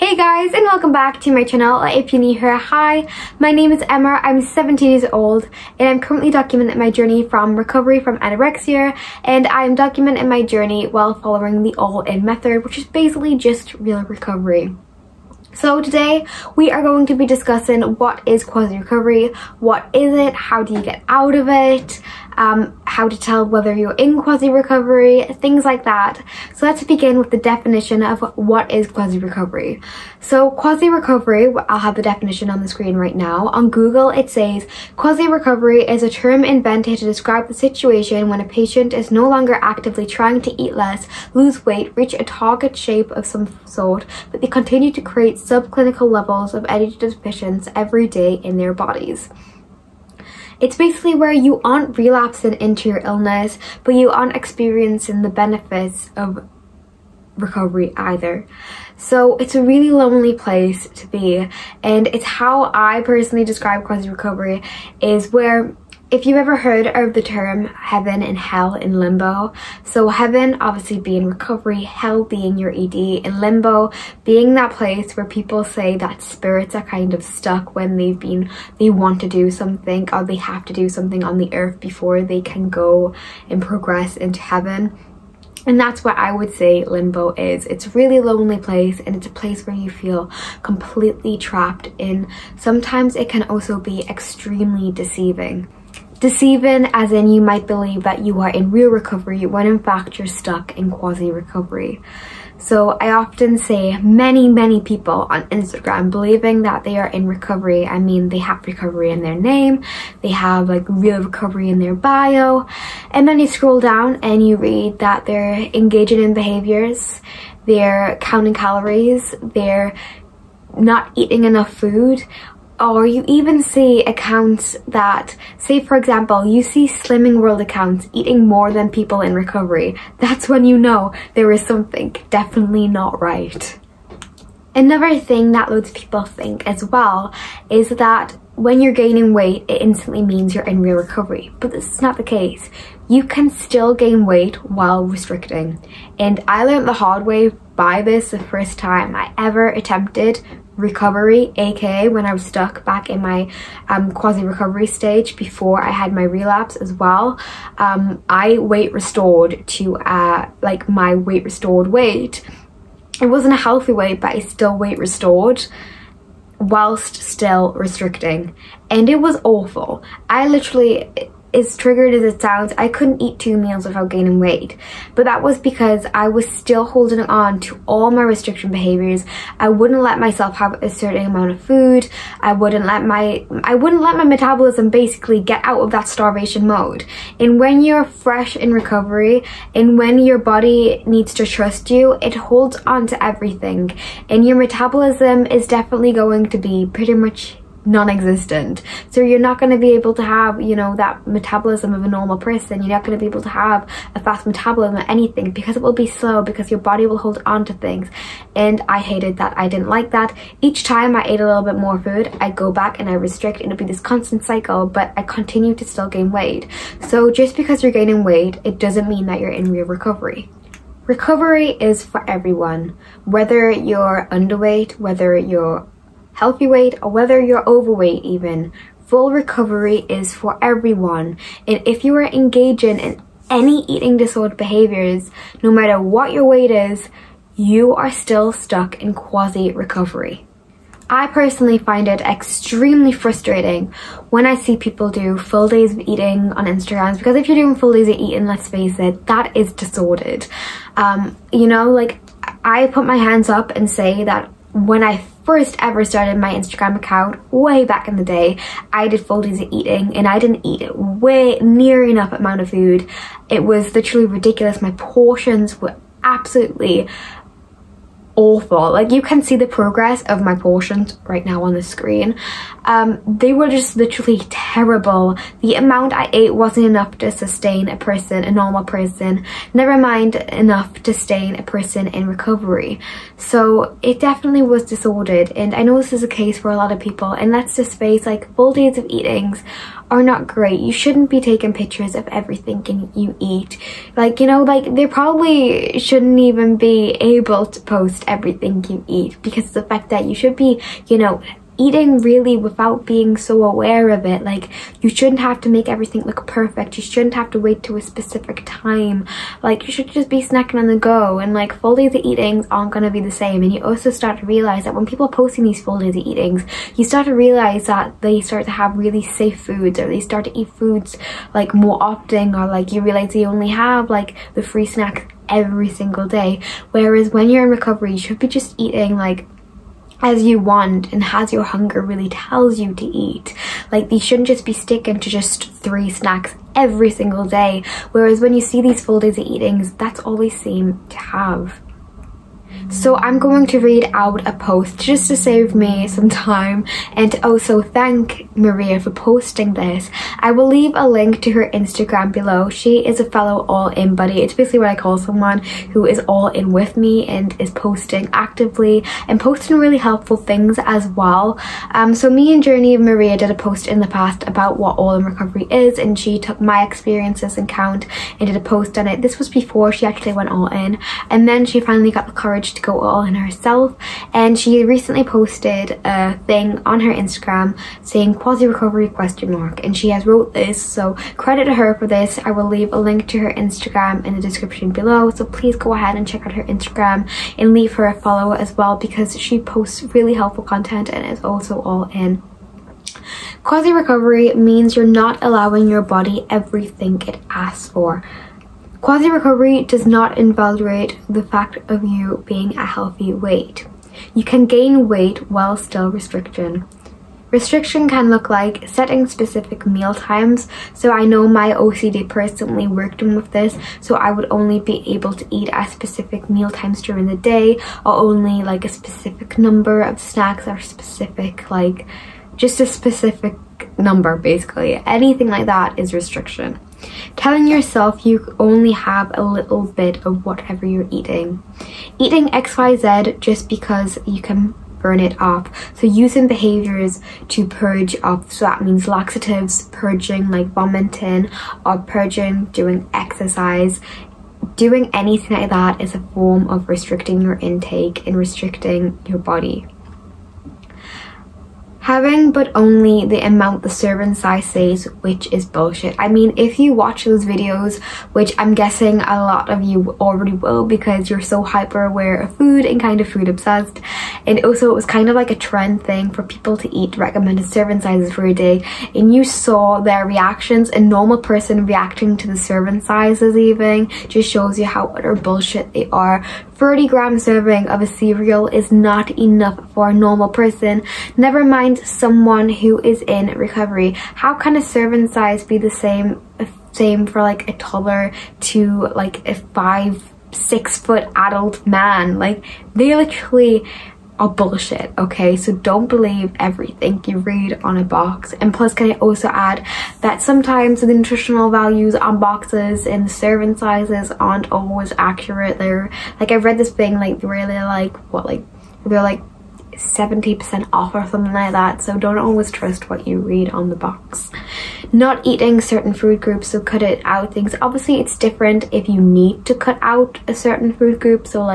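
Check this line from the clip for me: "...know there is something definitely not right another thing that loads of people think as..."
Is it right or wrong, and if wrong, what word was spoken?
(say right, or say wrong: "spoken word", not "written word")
right.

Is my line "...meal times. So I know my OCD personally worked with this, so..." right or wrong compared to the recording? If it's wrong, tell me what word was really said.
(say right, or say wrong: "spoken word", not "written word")
right.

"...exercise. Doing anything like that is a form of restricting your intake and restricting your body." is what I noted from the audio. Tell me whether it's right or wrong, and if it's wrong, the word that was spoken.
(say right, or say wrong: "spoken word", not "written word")
right.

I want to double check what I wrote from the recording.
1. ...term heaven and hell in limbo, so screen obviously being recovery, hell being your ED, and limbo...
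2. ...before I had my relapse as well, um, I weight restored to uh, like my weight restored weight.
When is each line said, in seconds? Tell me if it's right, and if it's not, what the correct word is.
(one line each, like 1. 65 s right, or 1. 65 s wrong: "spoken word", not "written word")
1. 67 s wrong: "heaven", not "screen"
2. 155 s right.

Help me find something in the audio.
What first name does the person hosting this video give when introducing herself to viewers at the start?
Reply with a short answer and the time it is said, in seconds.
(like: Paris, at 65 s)
Emma, at 3 s.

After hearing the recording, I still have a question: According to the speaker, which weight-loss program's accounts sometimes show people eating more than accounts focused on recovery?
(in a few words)
Slimming World.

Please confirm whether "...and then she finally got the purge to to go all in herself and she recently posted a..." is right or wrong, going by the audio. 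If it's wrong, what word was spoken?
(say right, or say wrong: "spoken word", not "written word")
wrong: "courage", not "purge".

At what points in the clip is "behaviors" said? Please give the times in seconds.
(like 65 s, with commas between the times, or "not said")
116 s, 178 s, 234 s, 436 s.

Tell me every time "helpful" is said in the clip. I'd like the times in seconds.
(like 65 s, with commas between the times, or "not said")
359 s, 390 s.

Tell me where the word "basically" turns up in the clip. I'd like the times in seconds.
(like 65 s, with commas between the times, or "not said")
12 s, 50 s, 184 s, 354 s, 424 s.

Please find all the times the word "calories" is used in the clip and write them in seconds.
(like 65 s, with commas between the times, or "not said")
118 s.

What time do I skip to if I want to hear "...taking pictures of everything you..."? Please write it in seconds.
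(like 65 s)
291 s.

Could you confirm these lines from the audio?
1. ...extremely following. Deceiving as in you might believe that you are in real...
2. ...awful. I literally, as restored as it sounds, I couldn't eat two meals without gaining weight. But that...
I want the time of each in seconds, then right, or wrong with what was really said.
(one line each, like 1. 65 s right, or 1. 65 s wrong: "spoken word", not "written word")
1. 94 s wrong: "deceiving", not "following"
2. 169 s wrong: "triggered", not "restored".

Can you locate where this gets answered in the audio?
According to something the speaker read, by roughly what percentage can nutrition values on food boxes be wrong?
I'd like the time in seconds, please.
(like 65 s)
509 s.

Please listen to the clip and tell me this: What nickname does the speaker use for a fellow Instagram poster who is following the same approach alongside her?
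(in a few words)
all-in buddy.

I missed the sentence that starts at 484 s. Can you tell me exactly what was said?
How can a serving size be the same, same for like a toddler to like a five, six foot adult man?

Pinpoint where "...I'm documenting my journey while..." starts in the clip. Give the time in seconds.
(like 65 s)
9 s.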